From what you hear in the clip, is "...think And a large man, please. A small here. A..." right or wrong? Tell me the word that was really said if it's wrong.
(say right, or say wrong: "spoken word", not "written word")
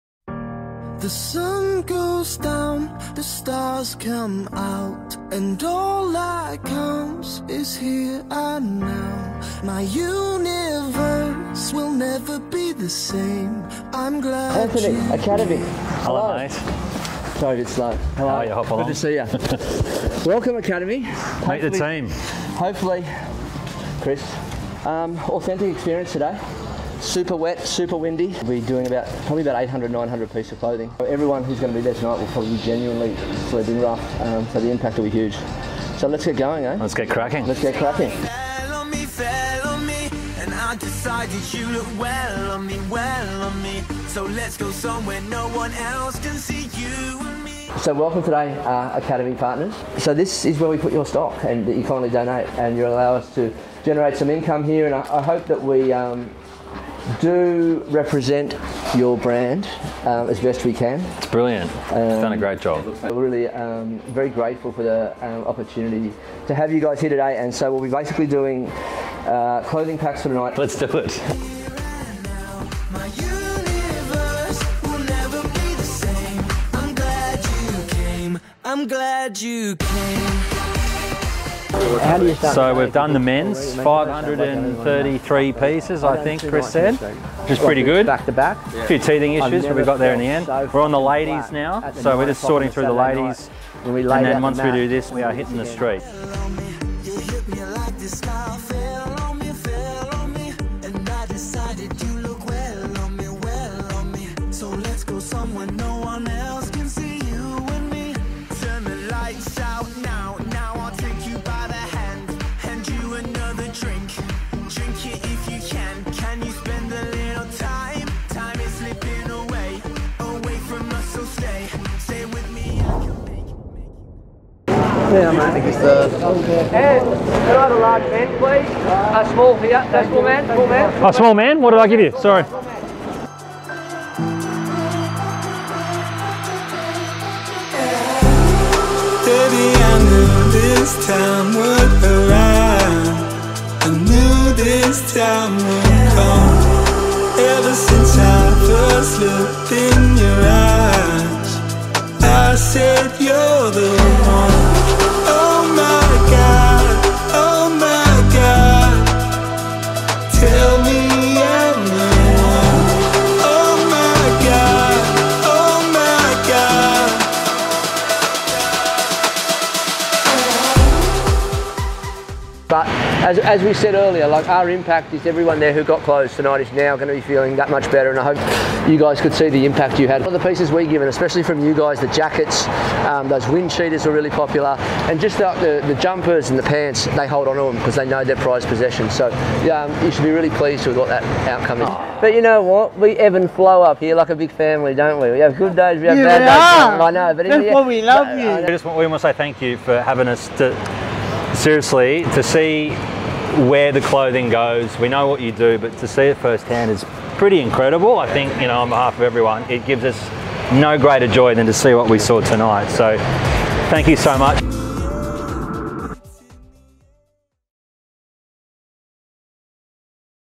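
right.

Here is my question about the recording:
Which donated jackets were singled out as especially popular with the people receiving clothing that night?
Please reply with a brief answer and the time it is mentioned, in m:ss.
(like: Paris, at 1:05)
Wind cheaters, at 3:03.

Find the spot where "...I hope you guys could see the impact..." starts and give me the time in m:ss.
2:58.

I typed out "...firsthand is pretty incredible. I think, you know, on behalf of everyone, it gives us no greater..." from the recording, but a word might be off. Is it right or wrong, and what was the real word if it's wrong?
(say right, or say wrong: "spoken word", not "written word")
right.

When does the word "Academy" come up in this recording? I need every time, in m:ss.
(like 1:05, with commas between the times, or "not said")
0:15, 0:20, 0:48.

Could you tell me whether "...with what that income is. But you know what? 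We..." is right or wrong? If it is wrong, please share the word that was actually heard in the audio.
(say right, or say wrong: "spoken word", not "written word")
wrong: "outcome", not "income".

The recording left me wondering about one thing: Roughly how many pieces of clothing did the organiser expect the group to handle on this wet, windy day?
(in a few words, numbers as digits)
800 to 900.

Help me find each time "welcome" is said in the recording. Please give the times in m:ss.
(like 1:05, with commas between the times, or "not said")
0:20, 0:47.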